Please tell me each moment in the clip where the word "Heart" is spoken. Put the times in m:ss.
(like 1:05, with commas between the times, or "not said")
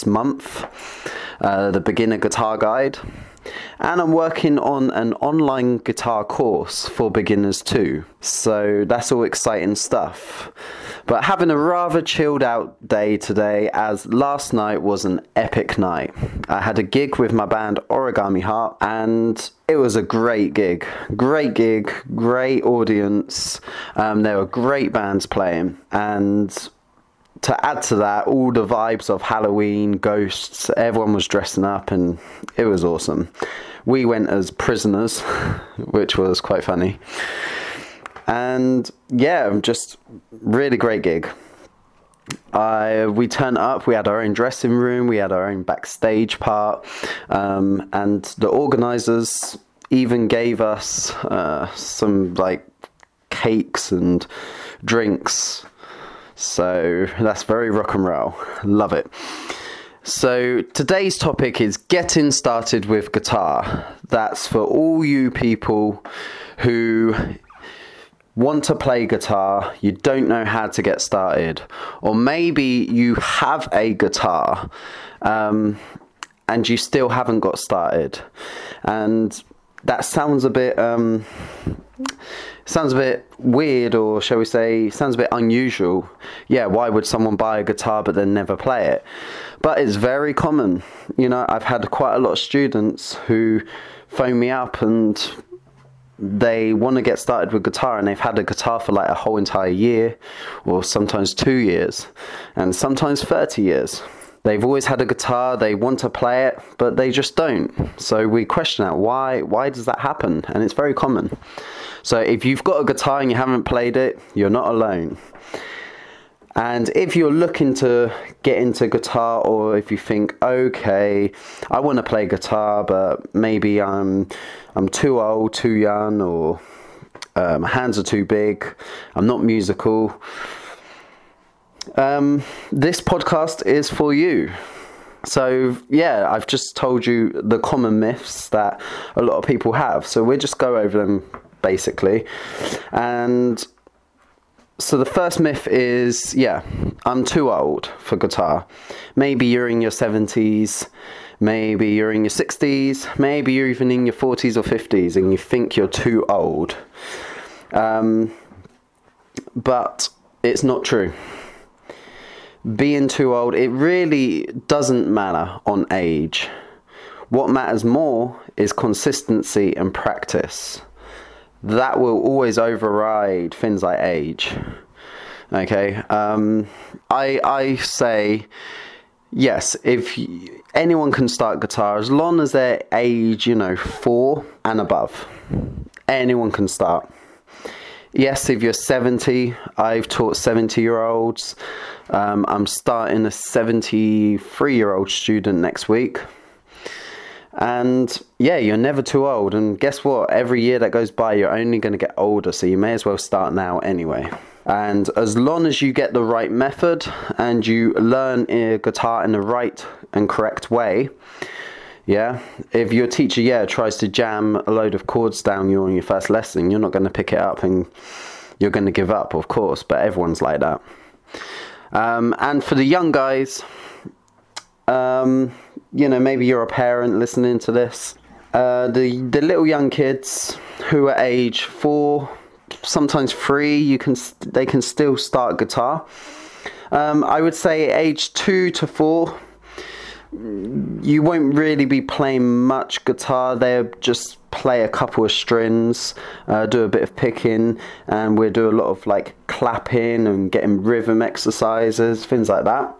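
0:18.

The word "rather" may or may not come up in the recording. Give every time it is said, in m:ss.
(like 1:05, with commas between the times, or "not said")
0:11.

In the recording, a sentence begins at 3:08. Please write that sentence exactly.
Yes, if you're 70, I've taught 70 year olds.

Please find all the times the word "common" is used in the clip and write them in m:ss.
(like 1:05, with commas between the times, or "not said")
1:30, 1:50, 2:17.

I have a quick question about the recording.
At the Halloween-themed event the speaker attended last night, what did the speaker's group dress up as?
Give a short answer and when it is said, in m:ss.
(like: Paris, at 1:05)
prisoners, at 0:34.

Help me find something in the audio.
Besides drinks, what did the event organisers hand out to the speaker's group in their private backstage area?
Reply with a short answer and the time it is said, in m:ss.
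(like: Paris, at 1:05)
cakes, at 0:53.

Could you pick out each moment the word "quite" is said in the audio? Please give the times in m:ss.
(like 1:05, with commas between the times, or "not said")
0:36, 1:31.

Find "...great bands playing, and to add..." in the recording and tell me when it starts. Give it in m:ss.
0:24.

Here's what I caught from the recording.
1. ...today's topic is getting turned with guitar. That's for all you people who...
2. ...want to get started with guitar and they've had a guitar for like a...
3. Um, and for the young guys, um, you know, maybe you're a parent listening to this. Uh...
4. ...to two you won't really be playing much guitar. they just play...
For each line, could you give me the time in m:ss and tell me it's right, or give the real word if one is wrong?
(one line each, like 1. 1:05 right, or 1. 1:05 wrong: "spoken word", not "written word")
1. 1:00 wrong: "started", not "turned"
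2. 1:36 right
3. 3:41 right
4. 3:58 wrong: "four", not "two".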